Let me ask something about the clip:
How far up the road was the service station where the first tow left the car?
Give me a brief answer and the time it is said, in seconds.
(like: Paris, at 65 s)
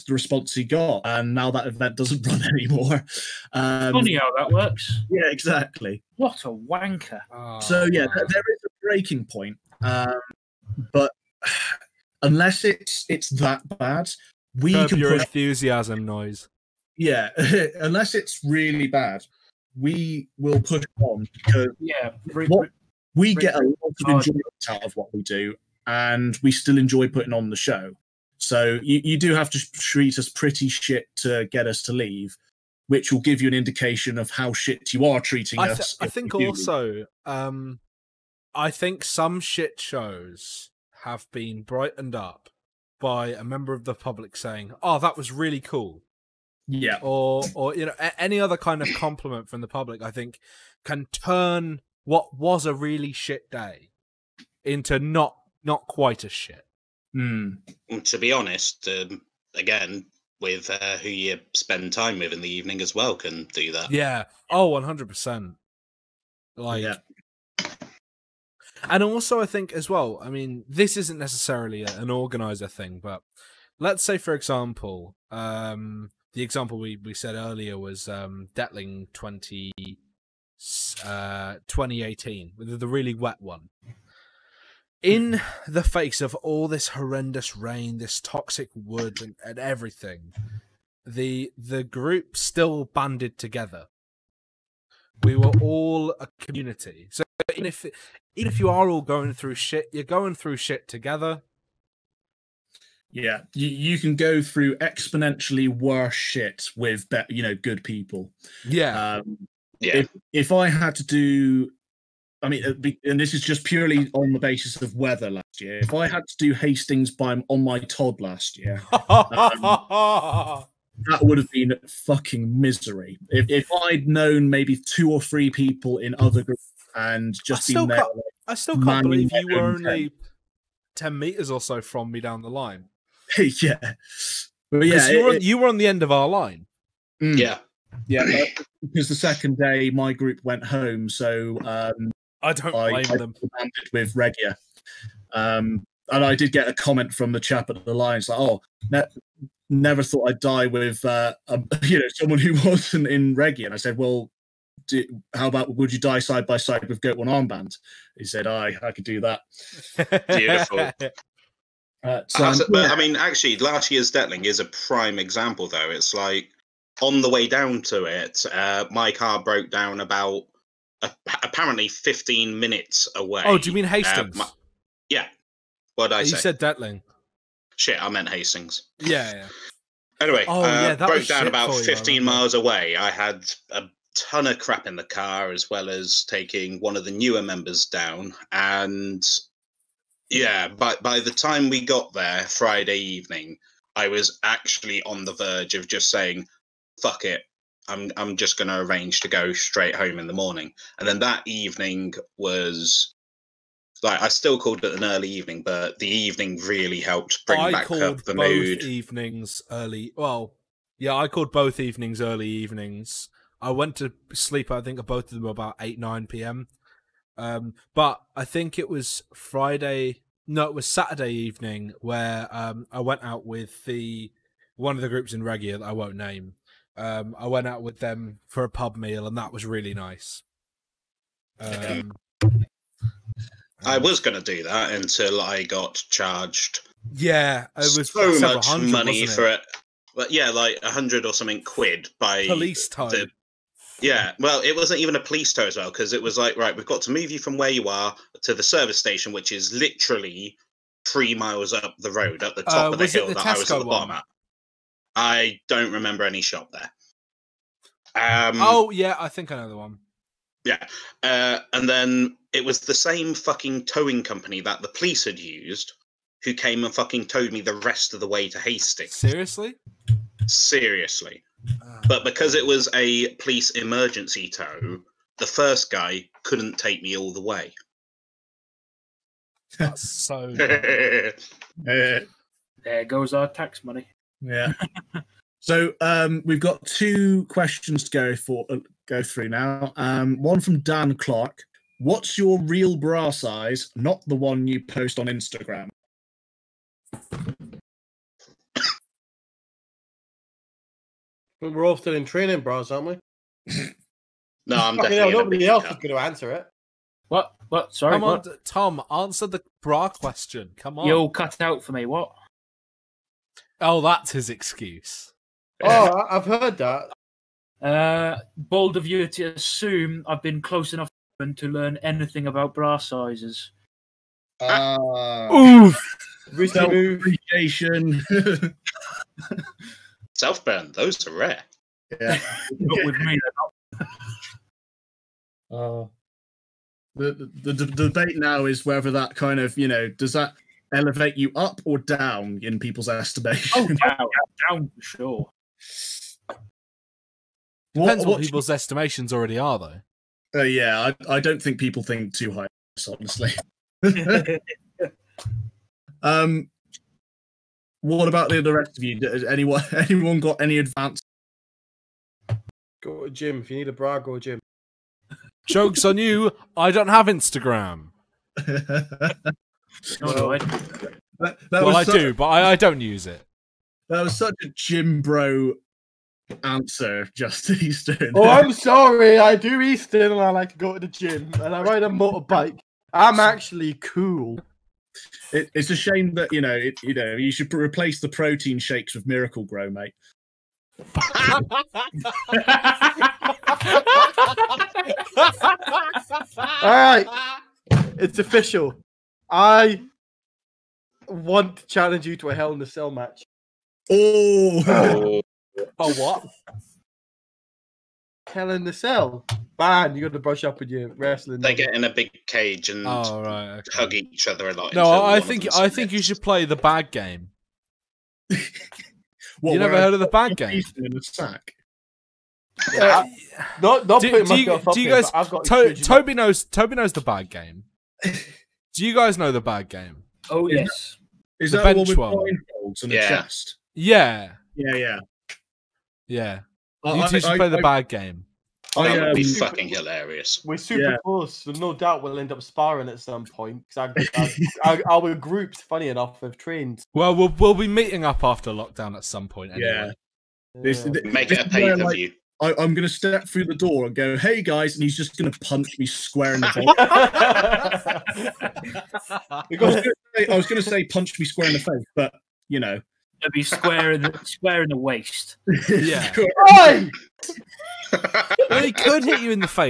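3 miles, at 251 s.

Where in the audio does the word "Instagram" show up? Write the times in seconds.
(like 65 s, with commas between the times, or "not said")
295 s, 367 s.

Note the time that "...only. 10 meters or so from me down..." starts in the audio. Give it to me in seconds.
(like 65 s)
129 s.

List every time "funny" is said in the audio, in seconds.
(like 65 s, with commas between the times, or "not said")
3 s, 445 s.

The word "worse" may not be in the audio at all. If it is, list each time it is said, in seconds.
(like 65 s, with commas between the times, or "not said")
105 s.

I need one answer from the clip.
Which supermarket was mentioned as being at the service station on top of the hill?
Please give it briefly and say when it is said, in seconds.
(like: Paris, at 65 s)
Tesco, at 253 s.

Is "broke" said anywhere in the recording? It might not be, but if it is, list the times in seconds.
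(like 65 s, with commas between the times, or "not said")
169 s, 180 s.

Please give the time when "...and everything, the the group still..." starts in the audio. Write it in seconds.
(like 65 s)
89 s.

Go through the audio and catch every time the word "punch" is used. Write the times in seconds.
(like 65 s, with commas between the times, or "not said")
455 s, 461 s.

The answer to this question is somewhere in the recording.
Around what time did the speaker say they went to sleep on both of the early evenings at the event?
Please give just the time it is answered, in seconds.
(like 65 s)
215 s.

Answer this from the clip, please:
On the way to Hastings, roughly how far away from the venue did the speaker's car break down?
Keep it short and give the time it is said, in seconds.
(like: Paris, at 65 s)
15 miles, at 181 s.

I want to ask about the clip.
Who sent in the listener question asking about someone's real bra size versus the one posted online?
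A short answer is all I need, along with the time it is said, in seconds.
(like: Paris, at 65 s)
Dan Clark, at 290 s.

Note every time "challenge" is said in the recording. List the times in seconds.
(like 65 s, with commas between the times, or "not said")
401 s.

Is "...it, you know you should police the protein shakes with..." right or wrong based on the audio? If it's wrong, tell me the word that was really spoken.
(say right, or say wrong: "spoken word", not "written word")
wrong: "replace", not "police".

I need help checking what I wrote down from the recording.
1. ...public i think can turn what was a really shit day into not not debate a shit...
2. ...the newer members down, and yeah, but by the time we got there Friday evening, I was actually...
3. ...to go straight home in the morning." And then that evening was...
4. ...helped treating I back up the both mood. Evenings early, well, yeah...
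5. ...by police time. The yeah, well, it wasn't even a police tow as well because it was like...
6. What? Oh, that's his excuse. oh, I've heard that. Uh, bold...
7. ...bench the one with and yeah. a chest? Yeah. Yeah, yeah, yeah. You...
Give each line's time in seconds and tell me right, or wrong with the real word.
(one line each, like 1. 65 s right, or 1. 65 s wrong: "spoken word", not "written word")
1. 49 s wrong: "quite", not "debate"
2. 187 s right
3. 199 s right
4. 206 s wrong: "bring", not "treating"
5. 242 s right
6. 312 s right
7. 431 s right.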